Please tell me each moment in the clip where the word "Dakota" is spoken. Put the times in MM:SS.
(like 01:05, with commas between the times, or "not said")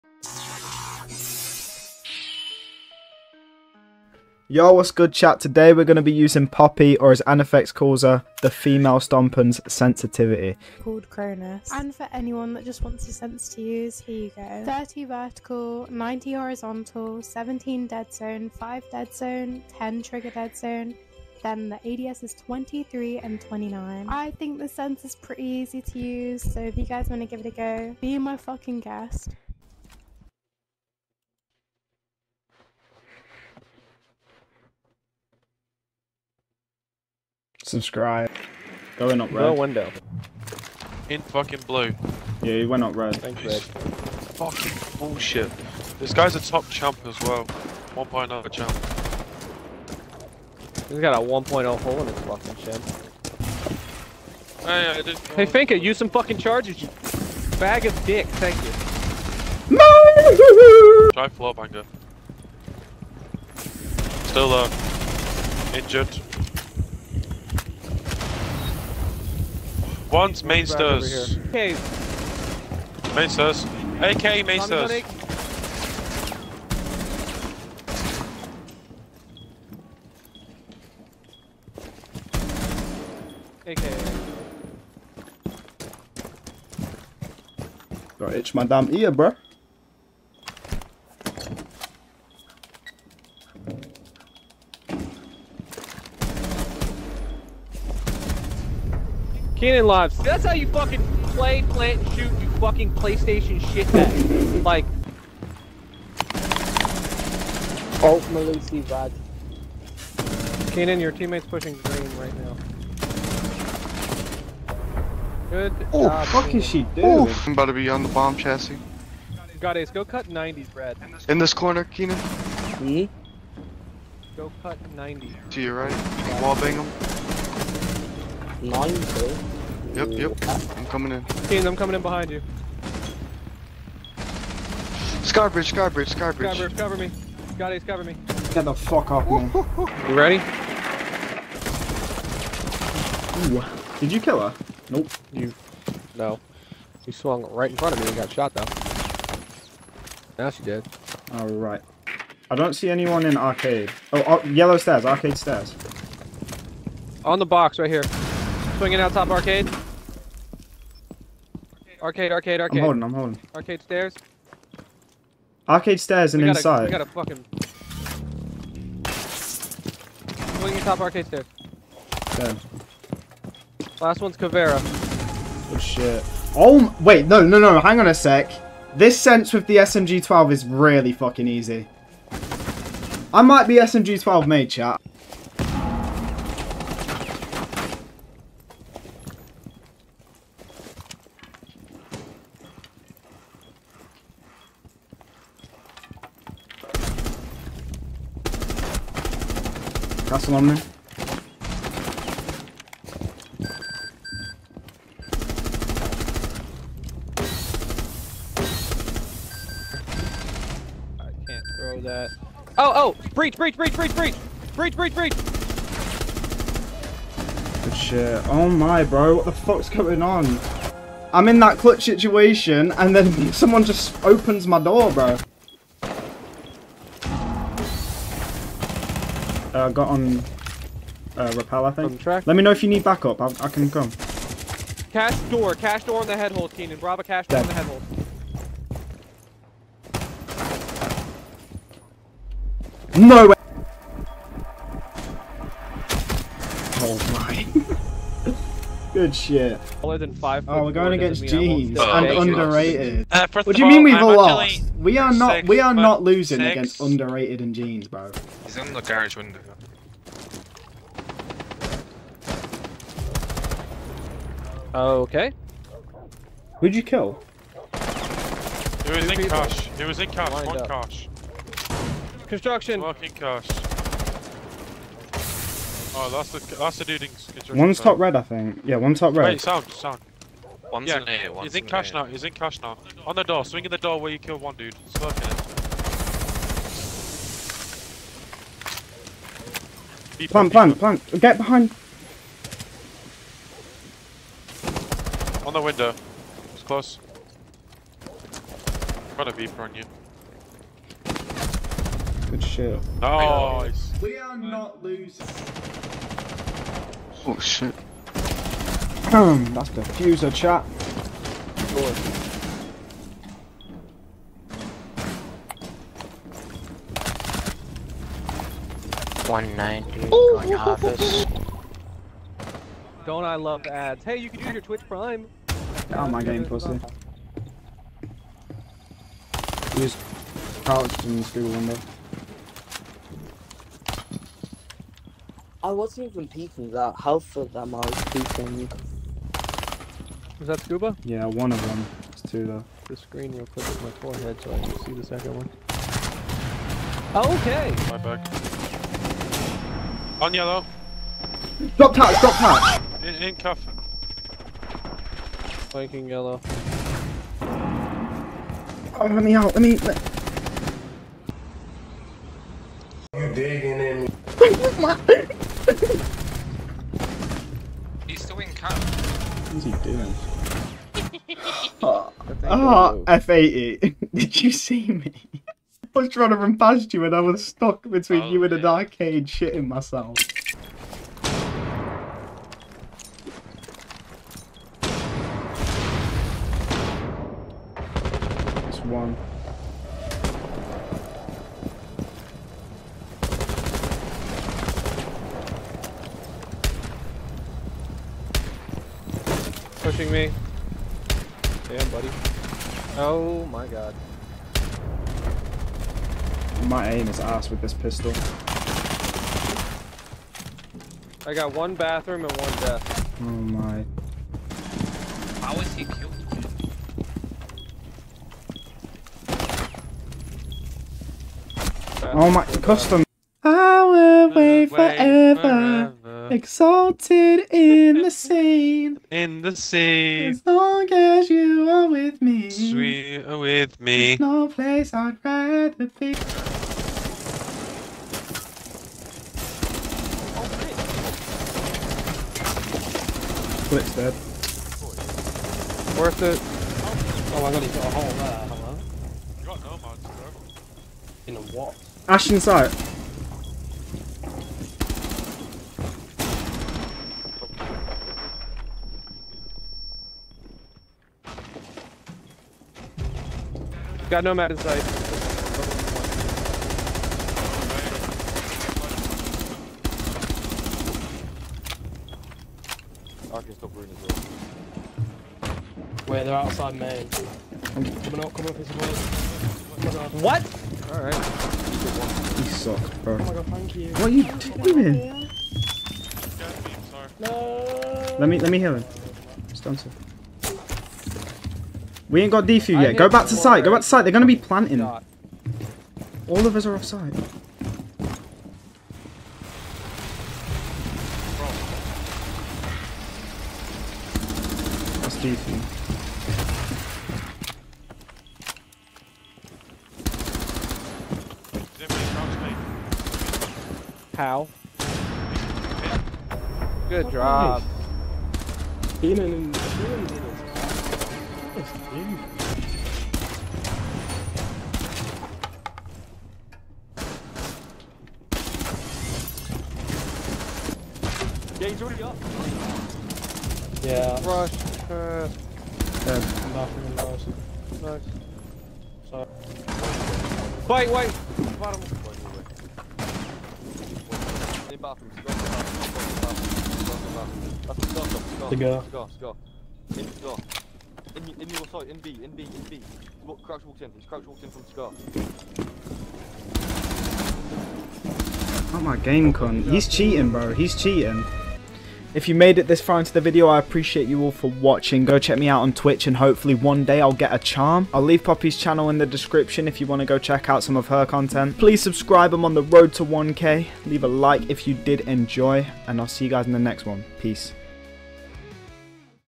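not said.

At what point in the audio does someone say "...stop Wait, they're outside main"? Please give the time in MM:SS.
07:53.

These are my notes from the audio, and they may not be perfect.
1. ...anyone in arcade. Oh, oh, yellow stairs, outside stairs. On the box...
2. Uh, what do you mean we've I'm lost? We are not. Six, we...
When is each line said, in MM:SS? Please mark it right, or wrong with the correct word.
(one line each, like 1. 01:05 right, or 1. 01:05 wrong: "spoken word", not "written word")
1. 02:32 wrong: "arcade", not "outside"
2. 04:13 right.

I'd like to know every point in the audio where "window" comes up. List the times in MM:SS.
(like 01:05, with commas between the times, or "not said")
00:39, 04:19, 04:55, 05:31.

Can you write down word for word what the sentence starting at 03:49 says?
uh, got on uh, rappel, I think.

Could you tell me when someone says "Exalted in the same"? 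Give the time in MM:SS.
07:06.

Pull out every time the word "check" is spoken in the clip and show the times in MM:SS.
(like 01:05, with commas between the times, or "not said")
09:25, 09:30.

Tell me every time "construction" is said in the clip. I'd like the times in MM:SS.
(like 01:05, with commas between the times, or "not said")
04:32, 04:37.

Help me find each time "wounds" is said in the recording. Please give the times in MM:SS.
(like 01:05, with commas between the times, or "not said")
not said.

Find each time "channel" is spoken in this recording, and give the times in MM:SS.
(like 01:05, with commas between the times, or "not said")
09:28.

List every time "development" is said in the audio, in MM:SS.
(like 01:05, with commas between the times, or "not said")
not said.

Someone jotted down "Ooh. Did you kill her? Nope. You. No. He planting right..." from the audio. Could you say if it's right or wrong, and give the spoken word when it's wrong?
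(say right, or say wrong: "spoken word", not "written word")
wrong: "swung", not "planting".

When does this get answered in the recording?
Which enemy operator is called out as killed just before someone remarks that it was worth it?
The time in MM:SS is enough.
07:23.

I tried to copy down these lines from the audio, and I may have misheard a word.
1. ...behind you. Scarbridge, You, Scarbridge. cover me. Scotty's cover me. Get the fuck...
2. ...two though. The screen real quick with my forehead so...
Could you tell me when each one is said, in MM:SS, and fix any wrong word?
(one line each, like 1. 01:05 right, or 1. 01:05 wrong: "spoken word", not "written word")
1. 02:12 wrong: "Scarbridge", not "You"
2. 05:42 right.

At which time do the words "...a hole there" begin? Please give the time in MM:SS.
07:28.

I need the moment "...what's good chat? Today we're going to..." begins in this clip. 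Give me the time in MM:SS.
00:04.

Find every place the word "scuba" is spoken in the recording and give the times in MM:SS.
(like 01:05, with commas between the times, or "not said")
05:40.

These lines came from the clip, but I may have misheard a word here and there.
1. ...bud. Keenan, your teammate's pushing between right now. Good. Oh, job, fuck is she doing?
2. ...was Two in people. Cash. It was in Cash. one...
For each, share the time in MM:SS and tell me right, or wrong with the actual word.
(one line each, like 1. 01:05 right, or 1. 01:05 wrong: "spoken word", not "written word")
1. 01:48 wrong: "green", not "between"
2. 04:27 right.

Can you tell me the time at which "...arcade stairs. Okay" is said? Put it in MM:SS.
02:50.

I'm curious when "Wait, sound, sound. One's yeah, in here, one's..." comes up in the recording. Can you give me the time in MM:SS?
04:39.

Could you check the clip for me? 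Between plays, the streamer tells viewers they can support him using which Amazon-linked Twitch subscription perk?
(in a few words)
Twitch Prime.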